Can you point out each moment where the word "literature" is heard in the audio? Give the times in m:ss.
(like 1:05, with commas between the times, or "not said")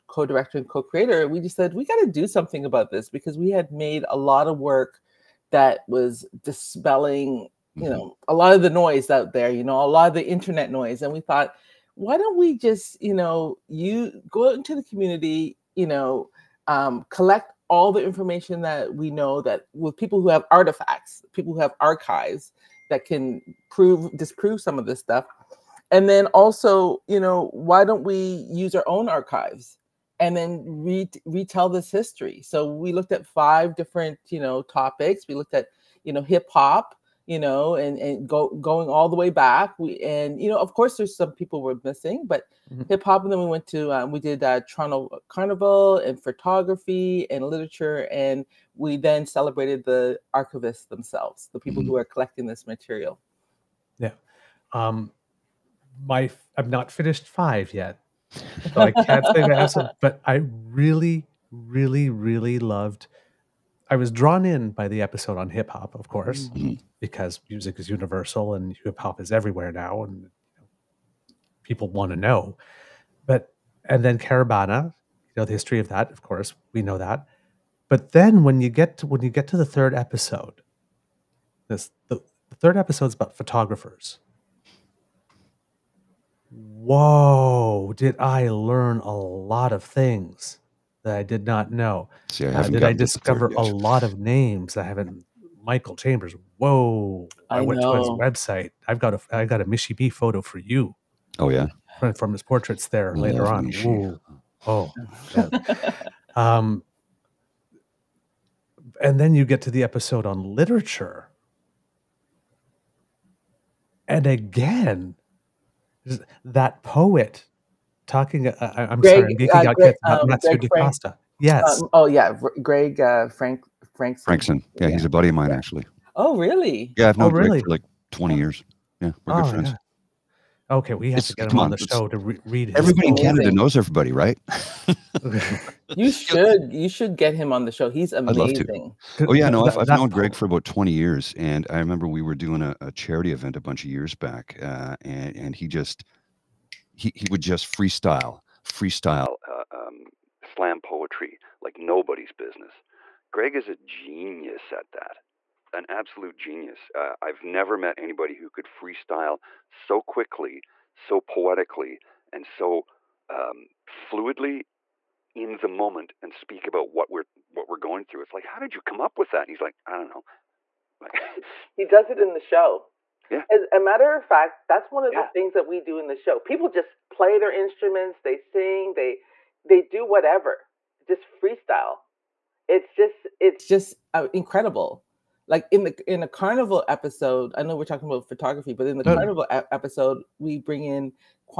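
0:47, 1:50.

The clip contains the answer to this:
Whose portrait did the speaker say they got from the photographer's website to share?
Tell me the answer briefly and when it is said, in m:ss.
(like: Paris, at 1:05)
Michie Mee, at 1:39.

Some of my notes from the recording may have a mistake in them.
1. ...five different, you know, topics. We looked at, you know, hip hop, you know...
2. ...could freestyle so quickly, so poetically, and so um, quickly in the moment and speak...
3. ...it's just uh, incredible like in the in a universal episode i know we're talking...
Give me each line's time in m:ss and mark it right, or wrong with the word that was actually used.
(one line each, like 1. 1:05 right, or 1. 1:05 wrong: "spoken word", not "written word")
1. 0:33 right
2. 2:38 wrong: "fluidly", not "quickly"
3. 3:03 wrong: "carnival", not "universal".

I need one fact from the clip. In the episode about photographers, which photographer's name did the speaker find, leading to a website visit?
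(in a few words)
Michael Chambers.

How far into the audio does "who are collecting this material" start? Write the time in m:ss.
0:51.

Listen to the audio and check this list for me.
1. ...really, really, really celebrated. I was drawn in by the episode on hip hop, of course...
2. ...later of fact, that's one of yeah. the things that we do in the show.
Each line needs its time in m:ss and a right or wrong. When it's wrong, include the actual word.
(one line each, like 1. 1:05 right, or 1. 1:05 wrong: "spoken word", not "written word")
1. 1:00 wrong: "loved", not "celebrated"
2. 2:53 wrong: "matter", not "later".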